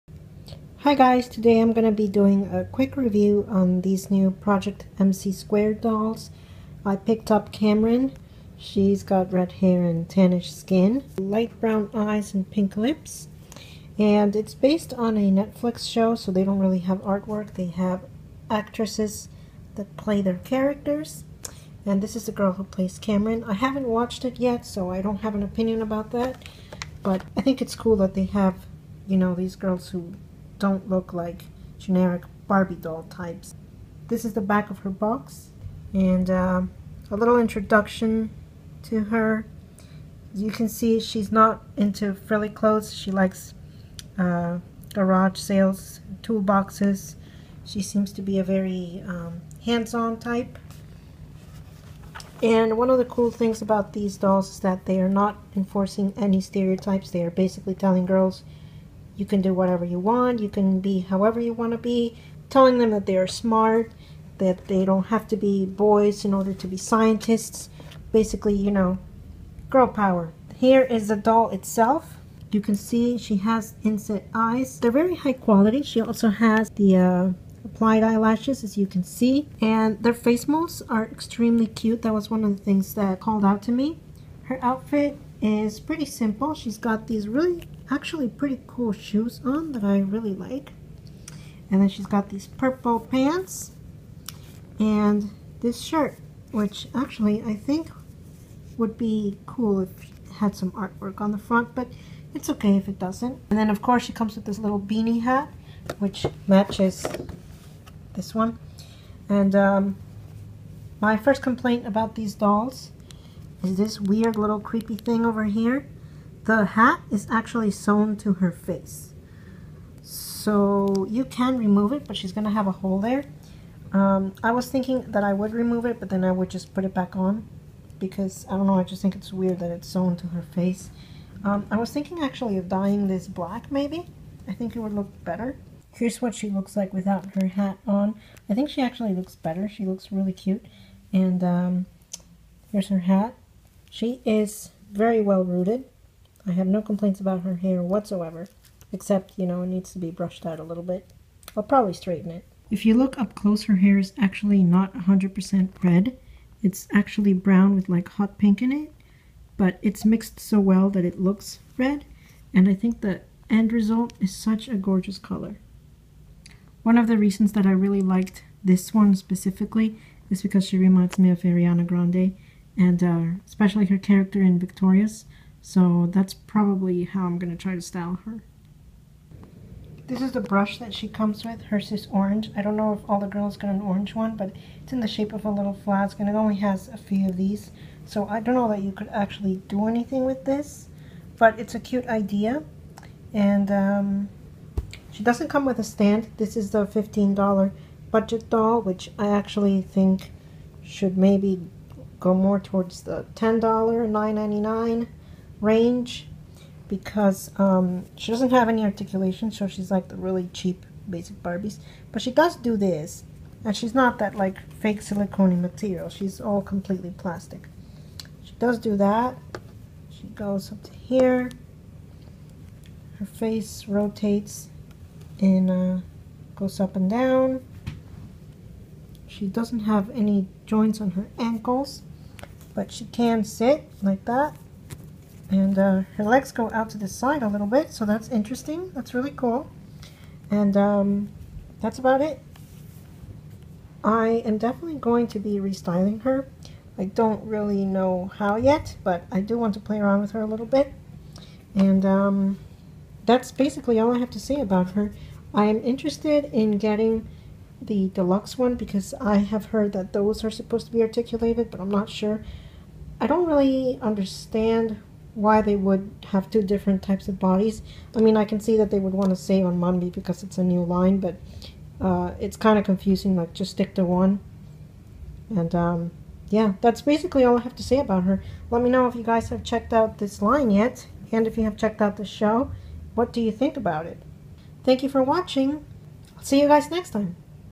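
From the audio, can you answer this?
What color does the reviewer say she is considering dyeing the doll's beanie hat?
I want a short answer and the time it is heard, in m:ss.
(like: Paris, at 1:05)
Black, at 2:13.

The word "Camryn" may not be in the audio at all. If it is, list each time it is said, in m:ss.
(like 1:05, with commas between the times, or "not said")
0:07, 0:22.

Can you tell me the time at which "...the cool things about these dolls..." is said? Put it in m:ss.
0:52.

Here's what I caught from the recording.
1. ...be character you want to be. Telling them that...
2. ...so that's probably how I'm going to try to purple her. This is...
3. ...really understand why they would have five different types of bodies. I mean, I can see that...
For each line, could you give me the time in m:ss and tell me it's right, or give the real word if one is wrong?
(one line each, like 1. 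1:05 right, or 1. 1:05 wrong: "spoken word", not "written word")
1. 1:00 wrong: "however", not "character"
2. 2:55 wrong: "style", not "purple"
3. 4:23 wrong: "two", not "five".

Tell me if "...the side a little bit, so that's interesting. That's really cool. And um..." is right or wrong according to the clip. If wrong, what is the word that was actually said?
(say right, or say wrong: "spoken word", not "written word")
right.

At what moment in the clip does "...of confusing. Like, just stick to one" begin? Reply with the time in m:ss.
4:32.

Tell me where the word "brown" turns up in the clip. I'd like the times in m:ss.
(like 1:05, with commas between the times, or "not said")
0:11, 2:37.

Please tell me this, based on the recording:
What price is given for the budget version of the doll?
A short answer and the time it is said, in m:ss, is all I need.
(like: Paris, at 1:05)
$15, at 3:16.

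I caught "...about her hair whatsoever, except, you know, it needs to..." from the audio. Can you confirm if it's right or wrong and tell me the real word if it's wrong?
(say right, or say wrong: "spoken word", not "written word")
right.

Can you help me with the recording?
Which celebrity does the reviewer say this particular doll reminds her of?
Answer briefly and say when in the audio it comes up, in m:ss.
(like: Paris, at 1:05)
Ariana Grande, at 2:51.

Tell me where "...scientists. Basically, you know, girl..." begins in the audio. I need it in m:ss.
1:06.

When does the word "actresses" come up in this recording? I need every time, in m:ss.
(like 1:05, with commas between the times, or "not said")
0:18.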